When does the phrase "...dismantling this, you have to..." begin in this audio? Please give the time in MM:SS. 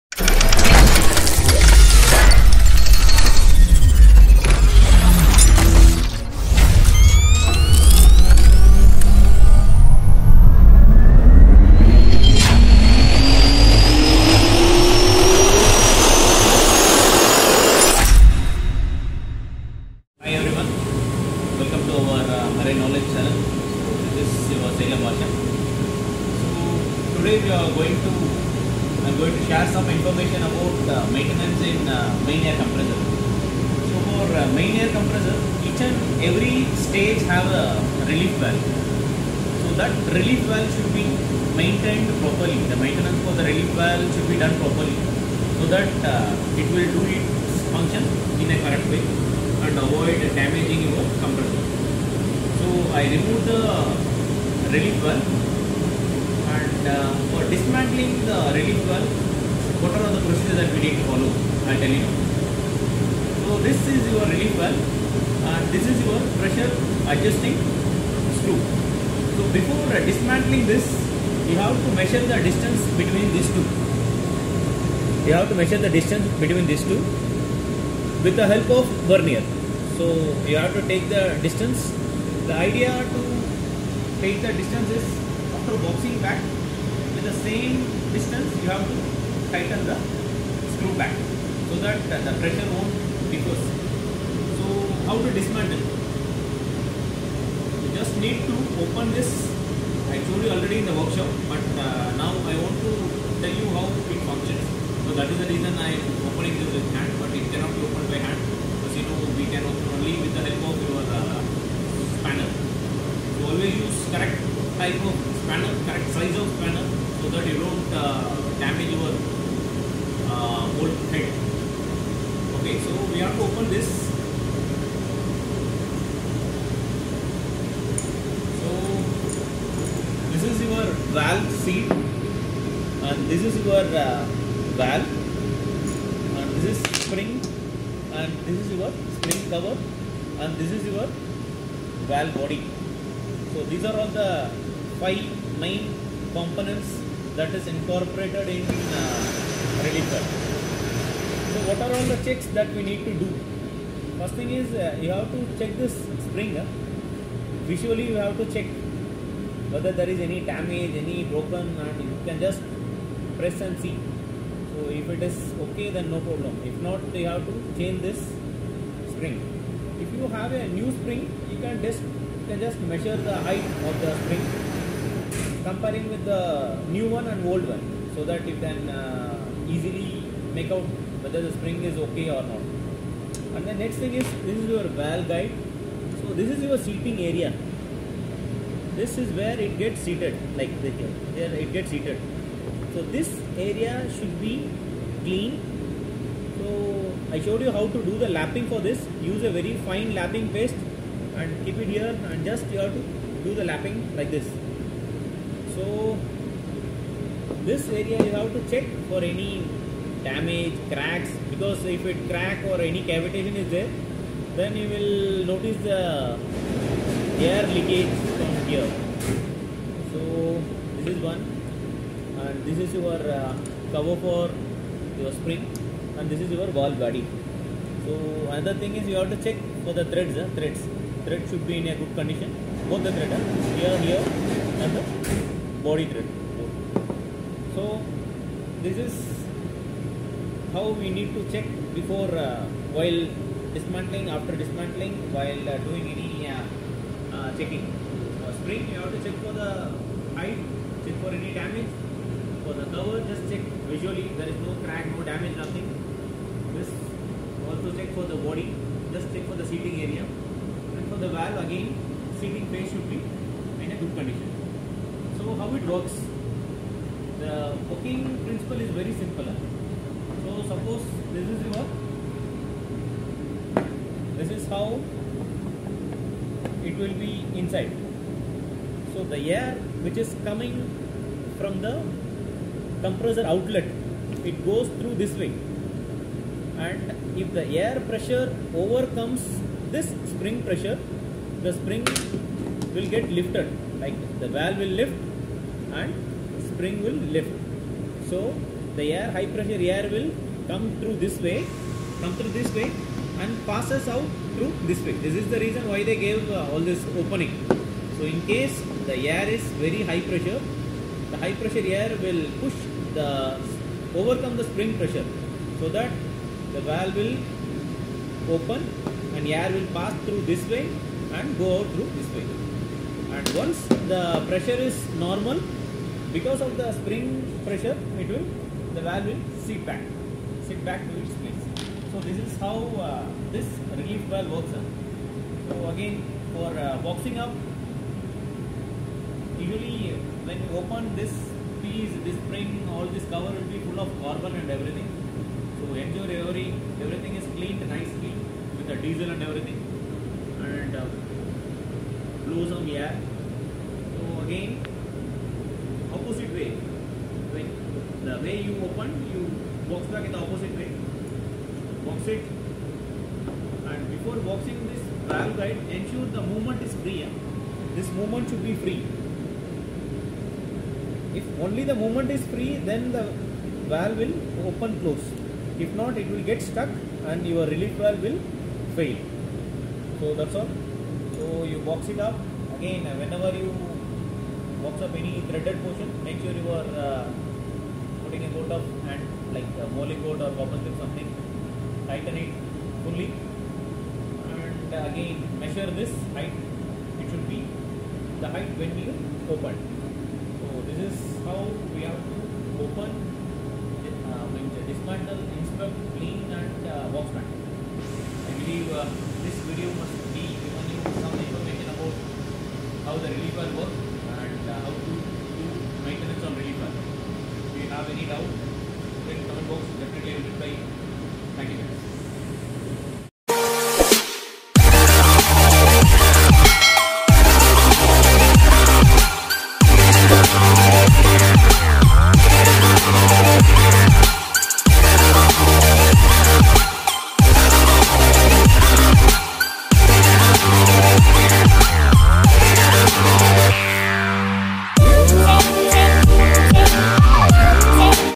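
01:10.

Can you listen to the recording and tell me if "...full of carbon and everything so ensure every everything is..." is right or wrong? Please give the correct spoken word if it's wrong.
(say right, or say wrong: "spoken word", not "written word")
right.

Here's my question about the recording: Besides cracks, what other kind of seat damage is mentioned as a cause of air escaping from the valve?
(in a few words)
Cavitation.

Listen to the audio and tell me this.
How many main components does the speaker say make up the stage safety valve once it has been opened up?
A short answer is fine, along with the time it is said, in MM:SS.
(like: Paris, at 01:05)
5, at 02:25.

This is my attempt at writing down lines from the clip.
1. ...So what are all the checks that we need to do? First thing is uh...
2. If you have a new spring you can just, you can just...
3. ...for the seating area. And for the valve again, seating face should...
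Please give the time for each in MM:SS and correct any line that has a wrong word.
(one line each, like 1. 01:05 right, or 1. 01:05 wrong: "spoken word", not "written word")
1. 02:31 right
2. 02:50 right
3. 04:19 right.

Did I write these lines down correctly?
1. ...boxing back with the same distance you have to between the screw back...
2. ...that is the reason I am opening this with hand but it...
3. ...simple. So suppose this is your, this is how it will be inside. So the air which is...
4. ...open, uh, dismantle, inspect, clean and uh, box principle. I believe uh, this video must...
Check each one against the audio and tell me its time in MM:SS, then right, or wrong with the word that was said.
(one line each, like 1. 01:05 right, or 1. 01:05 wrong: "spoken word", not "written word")
1. 01:25 wrong: "tighten", not "between"
2. 01:45 right
3. 04:29 right
4. 06:42 wrong: "mantle", not "principle".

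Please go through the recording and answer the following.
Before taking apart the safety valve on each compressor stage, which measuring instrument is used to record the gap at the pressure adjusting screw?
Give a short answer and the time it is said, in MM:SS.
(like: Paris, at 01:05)
Vernier, at 01:19.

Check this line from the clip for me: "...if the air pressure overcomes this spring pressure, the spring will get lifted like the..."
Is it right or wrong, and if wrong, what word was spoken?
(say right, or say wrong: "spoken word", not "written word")
right.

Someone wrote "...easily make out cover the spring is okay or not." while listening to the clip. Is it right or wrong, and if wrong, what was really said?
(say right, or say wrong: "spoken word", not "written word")
wrong: "whether", not "cover".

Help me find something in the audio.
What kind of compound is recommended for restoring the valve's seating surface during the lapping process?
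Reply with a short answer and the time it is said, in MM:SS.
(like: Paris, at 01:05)
Very fine lapping paste, at 03:19.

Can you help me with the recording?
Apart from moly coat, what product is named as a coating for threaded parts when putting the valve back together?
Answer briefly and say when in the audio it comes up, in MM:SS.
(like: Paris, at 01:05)
Copper slip, at 06:30.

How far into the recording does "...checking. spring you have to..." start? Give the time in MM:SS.
04:07.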